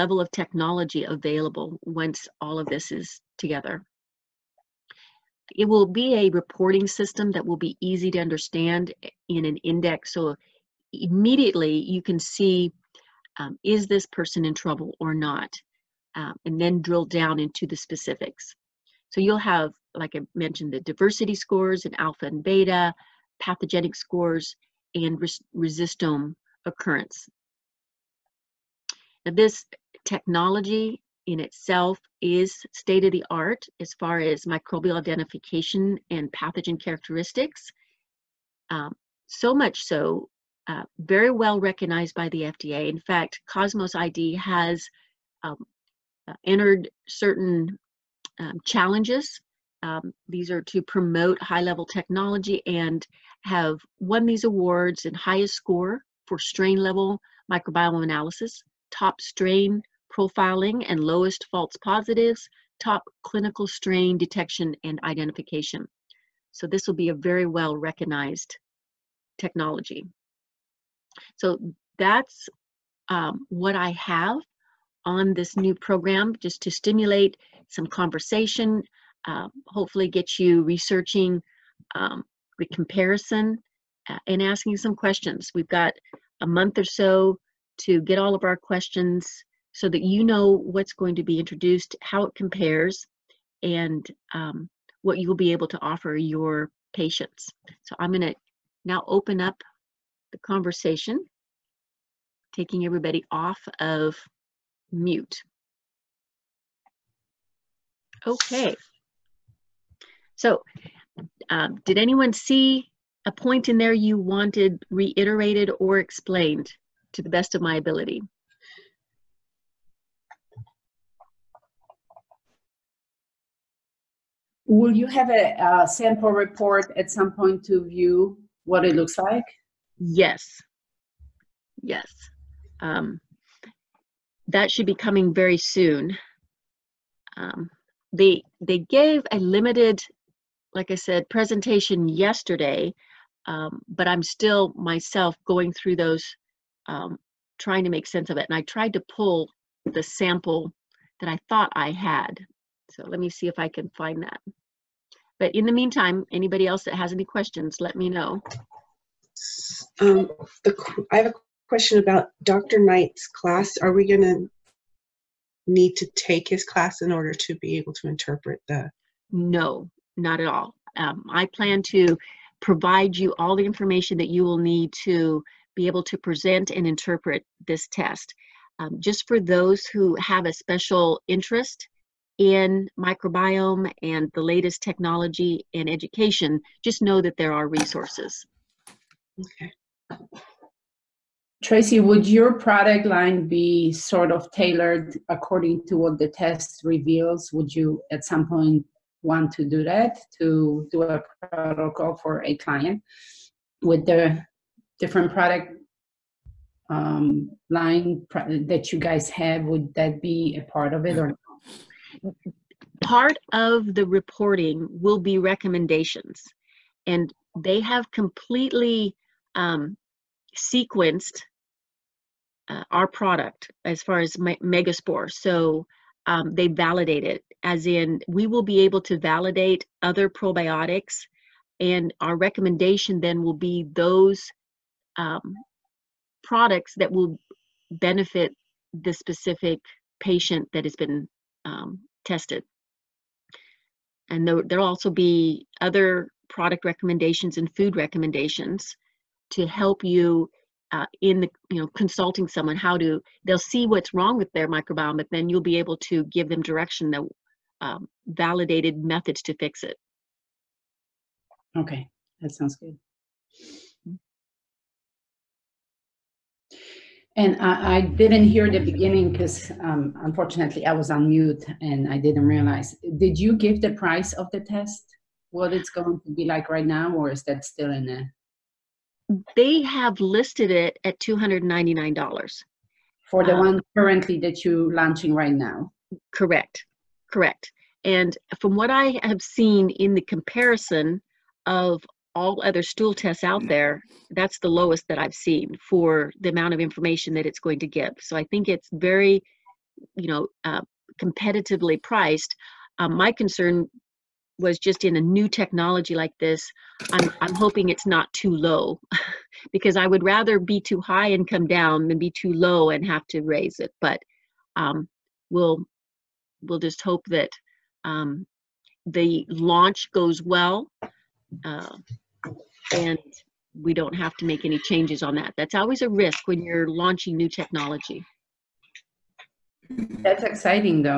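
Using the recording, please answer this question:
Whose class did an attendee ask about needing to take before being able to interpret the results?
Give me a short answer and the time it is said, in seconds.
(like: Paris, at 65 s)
Dr. Knight, at 162 s.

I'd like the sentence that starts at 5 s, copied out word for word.
It will be a reporting system that will be easy to understand in an index.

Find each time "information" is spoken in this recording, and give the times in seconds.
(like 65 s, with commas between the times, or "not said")
173 s, 296 s.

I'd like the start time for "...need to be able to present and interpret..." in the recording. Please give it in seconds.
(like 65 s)
174 s.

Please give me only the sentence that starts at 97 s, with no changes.
So I'm going to now open up the conversation, taking everybody off of mute.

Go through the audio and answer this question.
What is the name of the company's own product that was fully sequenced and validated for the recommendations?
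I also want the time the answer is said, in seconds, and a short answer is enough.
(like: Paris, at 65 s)
Megaspore, at 224 s.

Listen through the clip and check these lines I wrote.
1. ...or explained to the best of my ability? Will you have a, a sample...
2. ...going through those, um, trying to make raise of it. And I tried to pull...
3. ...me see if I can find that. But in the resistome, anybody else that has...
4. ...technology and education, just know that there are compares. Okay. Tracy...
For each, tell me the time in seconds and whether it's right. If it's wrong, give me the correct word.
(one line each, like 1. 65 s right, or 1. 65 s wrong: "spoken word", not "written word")
1. 115 s right
2. 145 s wrong: "sense", not "raise"
3. 153 s wrong: "meantime", not "resistome"
4. 184 s wrong: "resources", not "compares".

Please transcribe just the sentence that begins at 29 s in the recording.
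Now, this technology in itself is state of the art as far as microbial identification and pathogen characteristics.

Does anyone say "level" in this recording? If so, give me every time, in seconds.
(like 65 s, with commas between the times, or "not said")
51 s, 56 s.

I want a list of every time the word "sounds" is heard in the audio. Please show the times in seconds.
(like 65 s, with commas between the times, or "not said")
262 s.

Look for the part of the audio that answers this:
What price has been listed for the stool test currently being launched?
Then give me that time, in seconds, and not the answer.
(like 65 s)
281 s.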